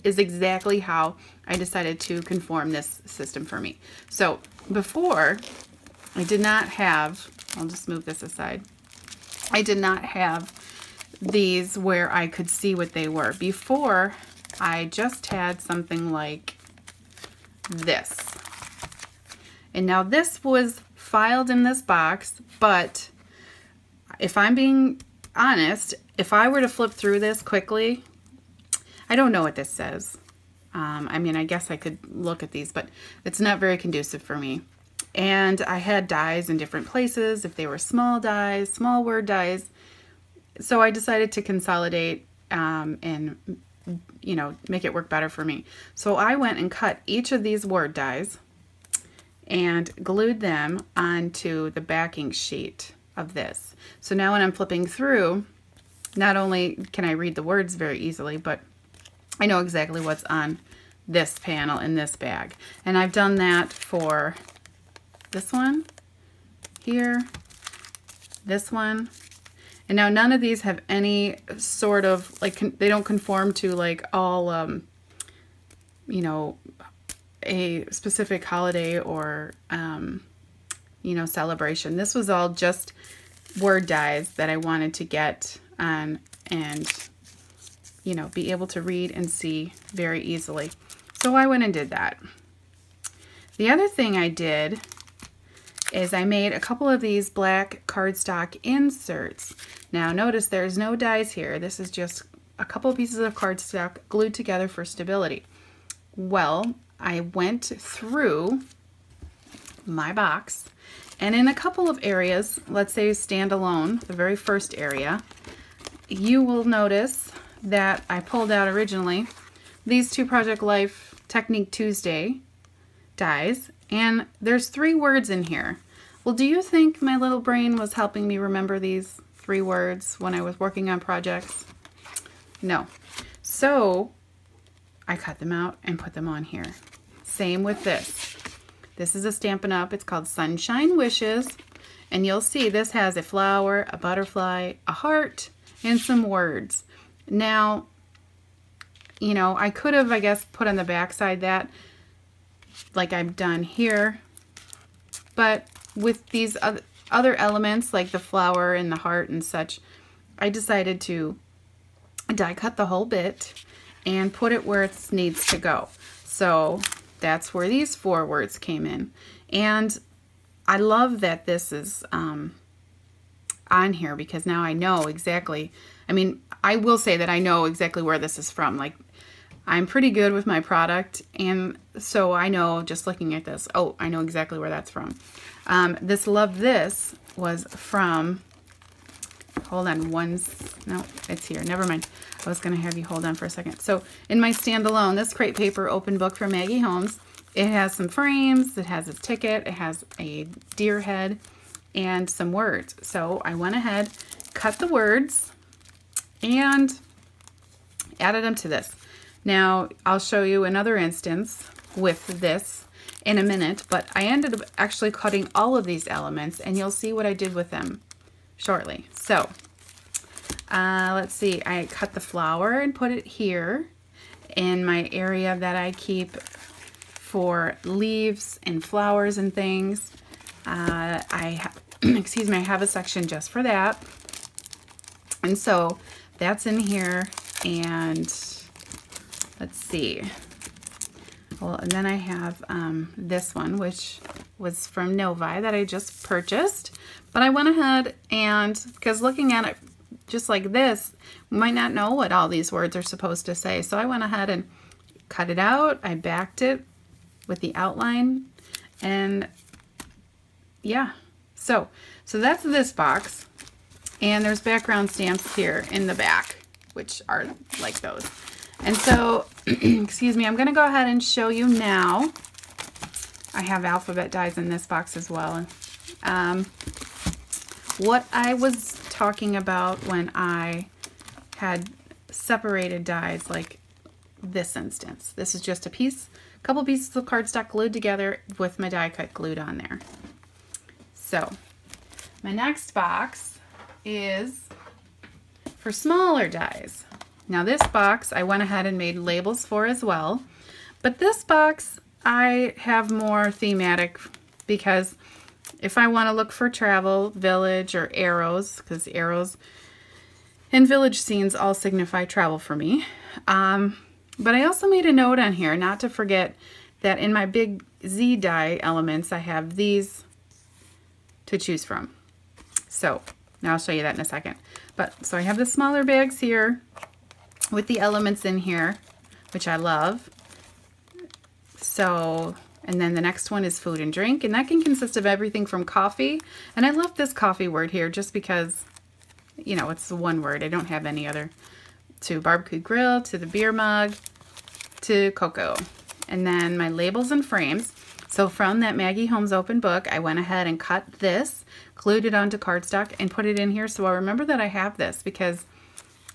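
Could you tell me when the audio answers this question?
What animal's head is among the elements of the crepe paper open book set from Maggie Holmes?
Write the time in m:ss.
3:20.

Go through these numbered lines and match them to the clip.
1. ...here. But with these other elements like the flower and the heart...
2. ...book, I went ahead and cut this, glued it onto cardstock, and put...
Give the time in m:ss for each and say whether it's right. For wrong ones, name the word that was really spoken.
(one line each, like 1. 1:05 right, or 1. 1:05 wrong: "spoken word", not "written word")
1. 2:33 right
2. 5:49 right.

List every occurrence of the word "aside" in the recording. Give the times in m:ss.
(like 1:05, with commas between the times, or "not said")
0:08.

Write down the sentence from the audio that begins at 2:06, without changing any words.
Well, do you think my little brain was helping me remember these three words when I was working on projects?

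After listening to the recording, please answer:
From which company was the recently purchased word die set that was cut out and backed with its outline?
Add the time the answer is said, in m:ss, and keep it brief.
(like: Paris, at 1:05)
Novi, at 4:05.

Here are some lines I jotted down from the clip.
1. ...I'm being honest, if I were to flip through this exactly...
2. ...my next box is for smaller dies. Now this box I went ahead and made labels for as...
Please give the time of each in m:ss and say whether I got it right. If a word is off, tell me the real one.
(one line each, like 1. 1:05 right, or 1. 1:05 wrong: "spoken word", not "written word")
1. 0:24 wrong: "quickly", not "exactly"
2. 4:52 right.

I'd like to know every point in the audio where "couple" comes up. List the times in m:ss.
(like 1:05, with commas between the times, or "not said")
1:36, 1:42, 1:51, 4:46.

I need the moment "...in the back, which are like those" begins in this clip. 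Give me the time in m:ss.
4:25.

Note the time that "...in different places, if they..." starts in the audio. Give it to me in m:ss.
0:36.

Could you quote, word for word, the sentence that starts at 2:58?
Like, I'm pretty good with my product, and so I know just looking at this, oh, I know exactly where that's from.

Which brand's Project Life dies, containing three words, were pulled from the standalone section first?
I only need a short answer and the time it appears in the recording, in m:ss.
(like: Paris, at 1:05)
Technique Tuesday, at 2:01.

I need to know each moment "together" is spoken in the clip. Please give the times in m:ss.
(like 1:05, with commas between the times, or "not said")
1:44, 4:47.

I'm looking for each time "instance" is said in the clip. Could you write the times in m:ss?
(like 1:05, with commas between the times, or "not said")
3:30, 4:44.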